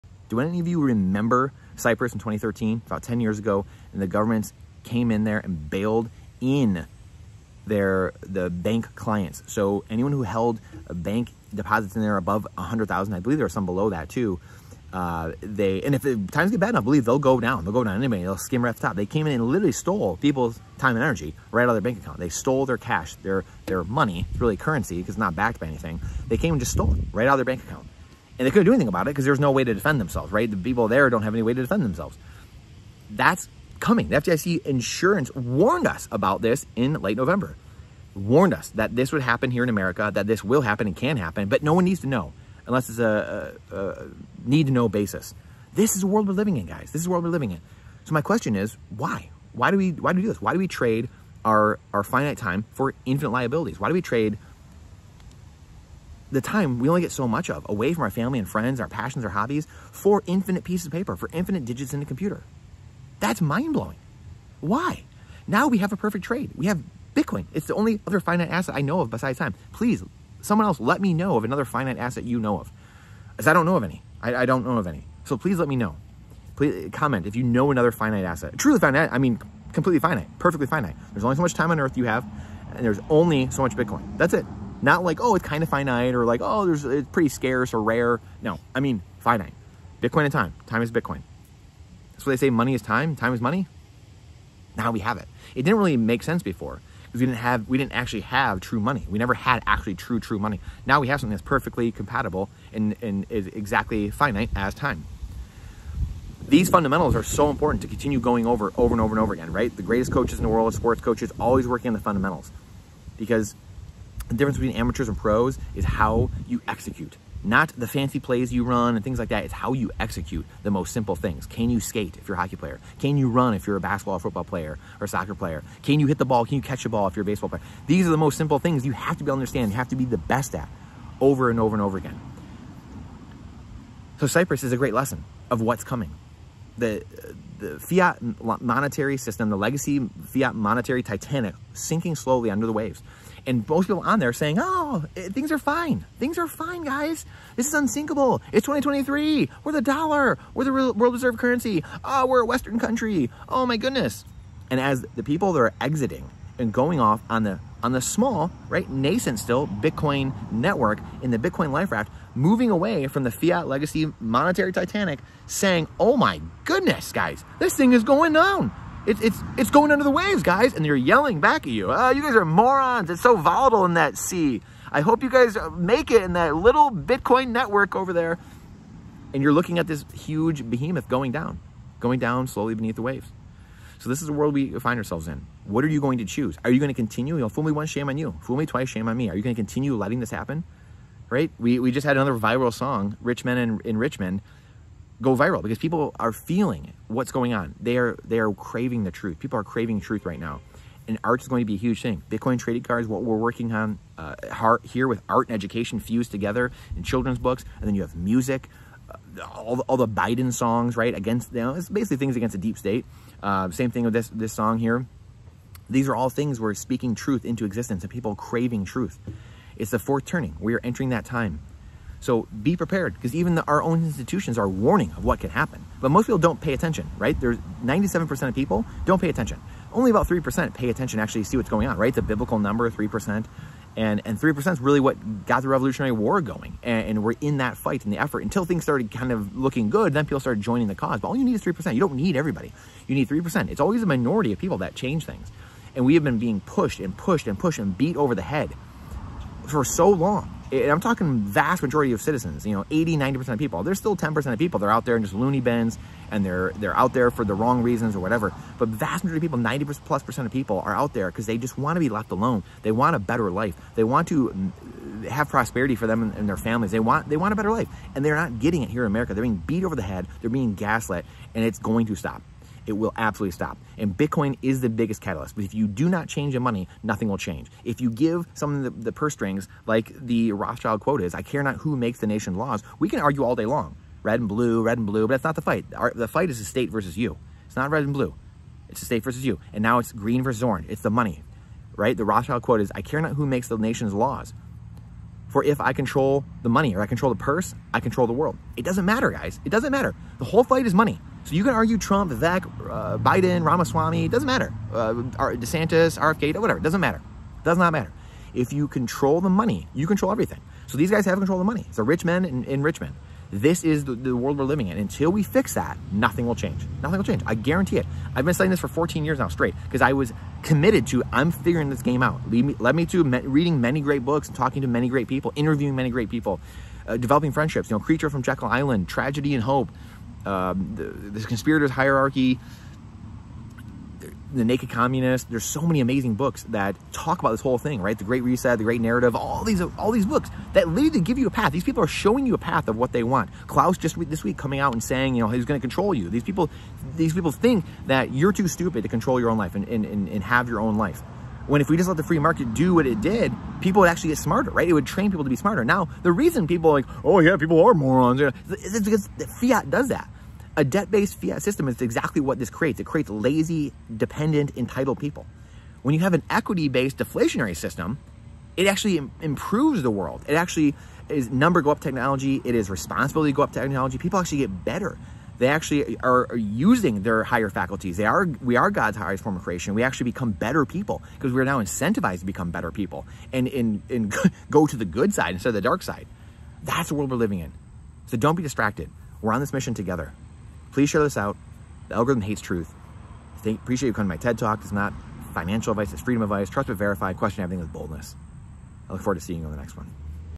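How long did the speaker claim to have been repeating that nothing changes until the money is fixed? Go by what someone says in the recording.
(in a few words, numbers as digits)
14 years.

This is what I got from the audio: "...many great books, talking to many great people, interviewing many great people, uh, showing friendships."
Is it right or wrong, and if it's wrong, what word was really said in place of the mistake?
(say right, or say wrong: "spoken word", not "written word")
wrong: "developing", not "showing".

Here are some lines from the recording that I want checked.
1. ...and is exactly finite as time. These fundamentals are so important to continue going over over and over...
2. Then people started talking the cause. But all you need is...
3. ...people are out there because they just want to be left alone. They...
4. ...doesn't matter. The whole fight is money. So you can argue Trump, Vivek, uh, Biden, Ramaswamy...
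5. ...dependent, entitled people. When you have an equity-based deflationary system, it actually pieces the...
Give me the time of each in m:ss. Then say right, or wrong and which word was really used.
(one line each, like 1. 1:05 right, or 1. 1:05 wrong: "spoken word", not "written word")
1. 1:43 right
2. 4:00 wrong: "joining", not "talking"
3. 4:20 right
4. 4:59 right
5. 6:04 wrong: "improves", not "pieces".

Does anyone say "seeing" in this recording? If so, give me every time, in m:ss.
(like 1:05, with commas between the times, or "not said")
6:39.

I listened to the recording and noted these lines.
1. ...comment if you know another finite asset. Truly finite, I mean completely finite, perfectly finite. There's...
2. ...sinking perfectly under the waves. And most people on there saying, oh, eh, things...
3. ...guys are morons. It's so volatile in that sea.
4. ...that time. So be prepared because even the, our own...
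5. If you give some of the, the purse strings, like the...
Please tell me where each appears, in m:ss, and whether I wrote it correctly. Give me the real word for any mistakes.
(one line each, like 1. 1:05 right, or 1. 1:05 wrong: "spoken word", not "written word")
1. 1:16 right
2. 2:21 wrong: "slowly", not "perfectly"
3. 2:52 right
4. 3:41 right
5. 4:37 right.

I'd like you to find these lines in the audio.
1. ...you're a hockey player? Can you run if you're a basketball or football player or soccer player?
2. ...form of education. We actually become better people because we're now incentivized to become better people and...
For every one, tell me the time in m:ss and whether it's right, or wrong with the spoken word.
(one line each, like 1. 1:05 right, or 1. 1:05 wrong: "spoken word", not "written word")
1. 2:02 right
2. 6:19 wrong: "creation", not "education".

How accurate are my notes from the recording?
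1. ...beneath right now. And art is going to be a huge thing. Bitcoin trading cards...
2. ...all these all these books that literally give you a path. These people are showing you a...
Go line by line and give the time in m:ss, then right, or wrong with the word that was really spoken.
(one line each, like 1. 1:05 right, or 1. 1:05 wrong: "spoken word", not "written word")
1. 3:20 wrong: "truth", not "beneath"
2. 5:39 right.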